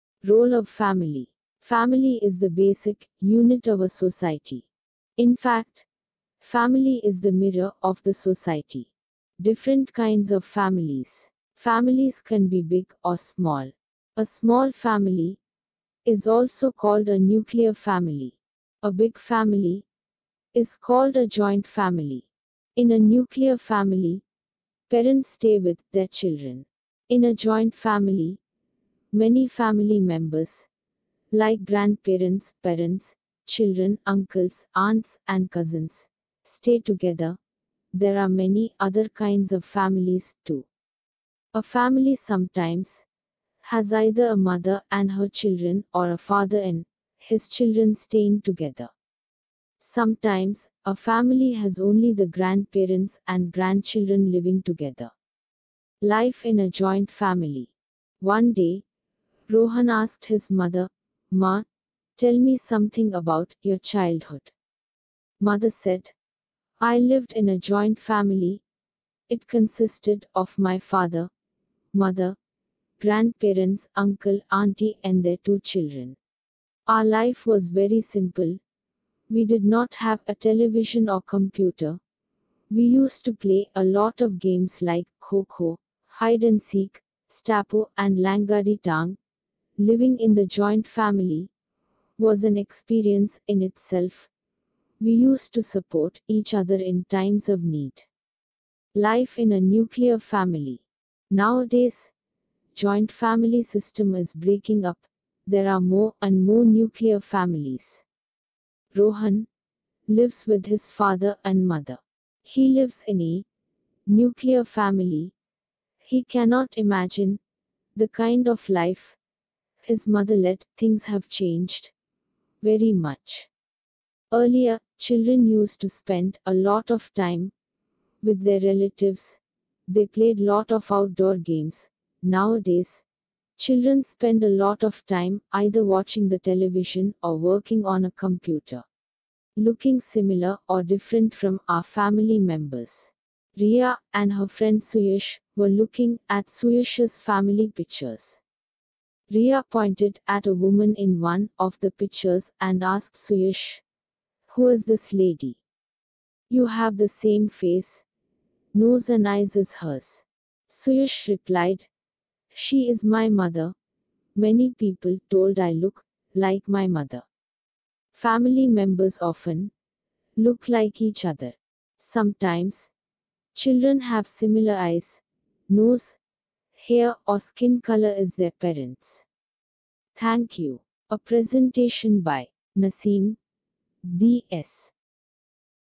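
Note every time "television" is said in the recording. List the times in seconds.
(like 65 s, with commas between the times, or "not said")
80 s, 136 s.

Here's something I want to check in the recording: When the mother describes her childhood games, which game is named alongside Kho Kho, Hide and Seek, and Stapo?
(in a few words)
Langari Tang.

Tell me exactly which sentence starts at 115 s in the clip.
He cannot imagine the kind of life his mother led, things have changed.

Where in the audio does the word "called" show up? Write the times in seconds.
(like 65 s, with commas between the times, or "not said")
16 s, 20 s.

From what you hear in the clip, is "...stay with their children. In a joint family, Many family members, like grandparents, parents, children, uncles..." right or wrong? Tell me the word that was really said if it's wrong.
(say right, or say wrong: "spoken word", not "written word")
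right.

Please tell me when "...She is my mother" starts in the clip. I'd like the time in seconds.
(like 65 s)
162 s.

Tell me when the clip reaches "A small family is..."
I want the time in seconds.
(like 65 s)
14 s.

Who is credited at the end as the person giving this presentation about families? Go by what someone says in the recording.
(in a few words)
Nasim D.S.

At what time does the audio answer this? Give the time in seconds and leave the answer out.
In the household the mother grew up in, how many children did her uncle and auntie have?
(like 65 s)
75 s.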